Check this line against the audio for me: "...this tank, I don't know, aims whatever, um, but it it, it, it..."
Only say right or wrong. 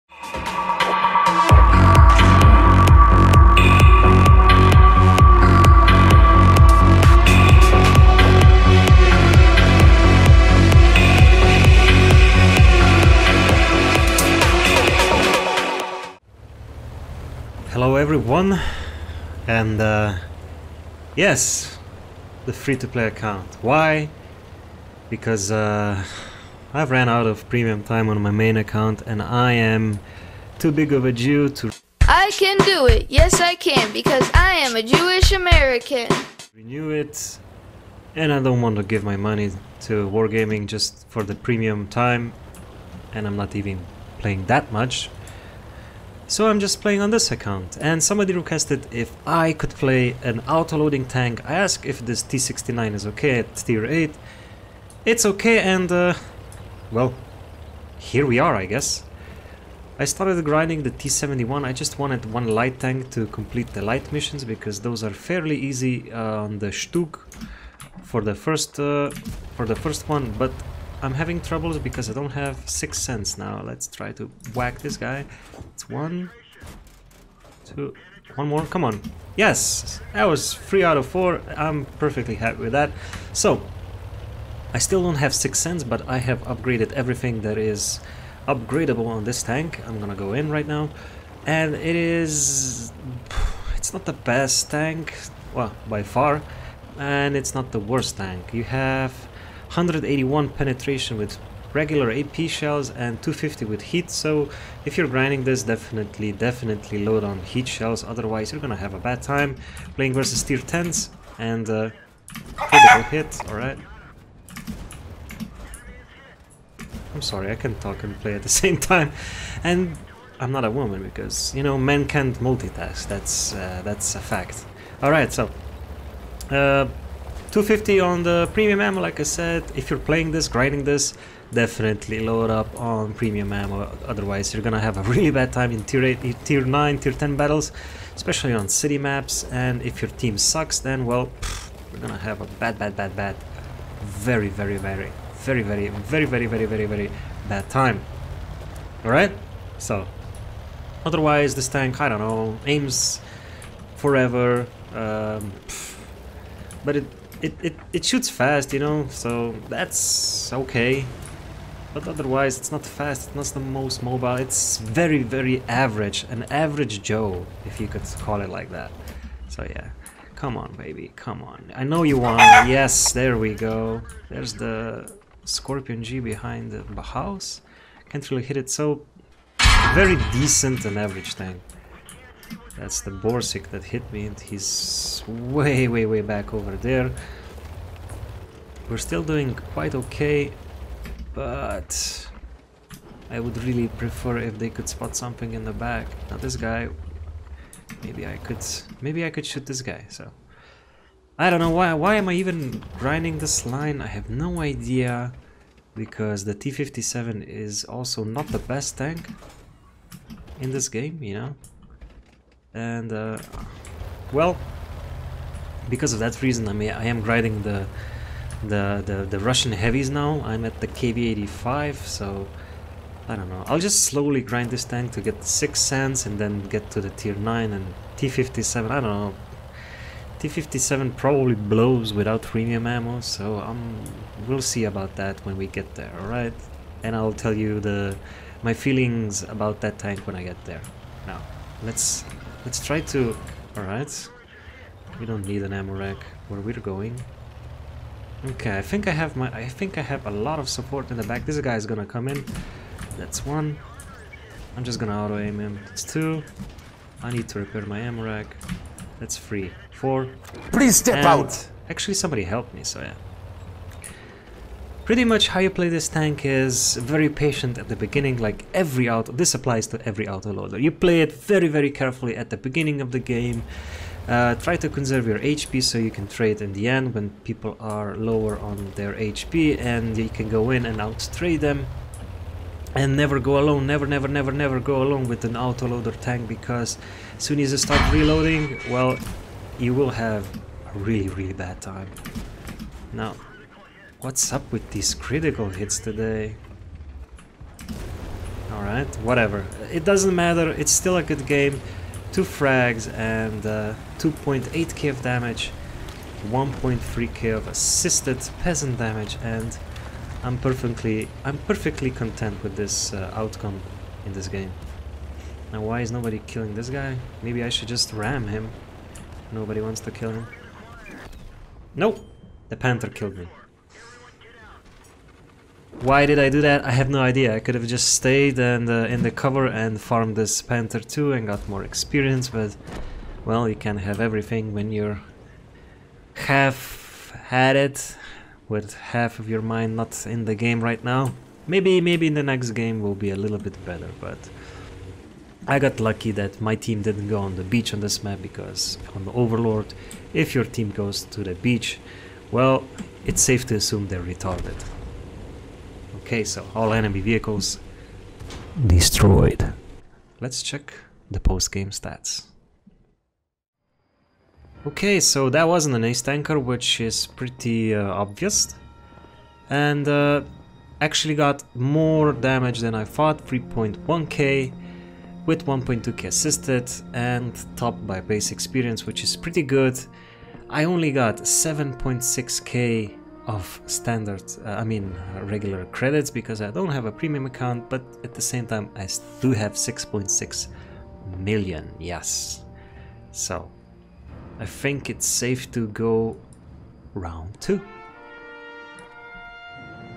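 wrong.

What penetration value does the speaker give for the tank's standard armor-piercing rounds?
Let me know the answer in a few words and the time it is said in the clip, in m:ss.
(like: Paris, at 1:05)
181, at 1:39.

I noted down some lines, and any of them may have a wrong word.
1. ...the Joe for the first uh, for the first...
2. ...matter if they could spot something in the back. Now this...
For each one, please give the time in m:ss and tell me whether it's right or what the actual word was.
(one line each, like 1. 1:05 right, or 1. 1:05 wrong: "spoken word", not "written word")
1. 1:06 wrong: "Stug", not "Joe"
2. 3:14 wrong: "prefer", not "matter".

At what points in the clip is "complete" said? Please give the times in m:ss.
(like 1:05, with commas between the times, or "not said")
1:03.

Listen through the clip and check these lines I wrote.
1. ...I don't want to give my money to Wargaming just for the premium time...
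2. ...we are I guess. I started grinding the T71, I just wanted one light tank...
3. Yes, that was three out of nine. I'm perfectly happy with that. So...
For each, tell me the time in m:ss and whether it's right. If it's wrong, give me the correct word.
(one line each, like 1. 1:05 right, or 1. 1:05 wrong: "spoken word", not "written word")
1. 0:38 right
2. 0:58 right
3. 1:19 wrong: "four", not "nine".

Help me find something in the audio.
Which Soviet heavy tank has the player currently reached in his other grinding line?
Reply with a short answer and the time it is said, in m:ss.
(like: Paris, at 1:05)
KV85, at 3:40.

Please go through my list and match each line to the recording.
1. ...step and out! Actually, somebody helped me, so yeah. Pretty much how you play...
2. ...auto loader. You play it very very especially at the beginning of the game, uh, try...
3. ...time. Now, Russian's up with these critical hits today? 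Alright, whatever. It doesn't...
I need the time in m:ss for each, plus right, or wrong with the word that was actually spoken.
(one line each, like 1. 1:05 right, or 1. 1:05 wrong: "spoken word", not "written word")
1. 4:20 right
2. 4:30 wrong: "carefully", not "especially"
3. 4:51 wrong: "What", not "Russian".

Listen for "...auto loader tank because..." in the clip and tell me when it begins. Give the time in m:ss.
4:45.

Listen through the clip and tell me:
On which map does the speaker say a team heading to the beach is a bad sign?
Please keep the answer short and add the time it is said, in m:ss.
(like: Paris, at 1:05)
Overlord, at 5:49.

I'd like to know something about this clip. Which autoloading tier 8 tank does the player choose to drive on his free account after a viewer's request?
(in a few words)
T69.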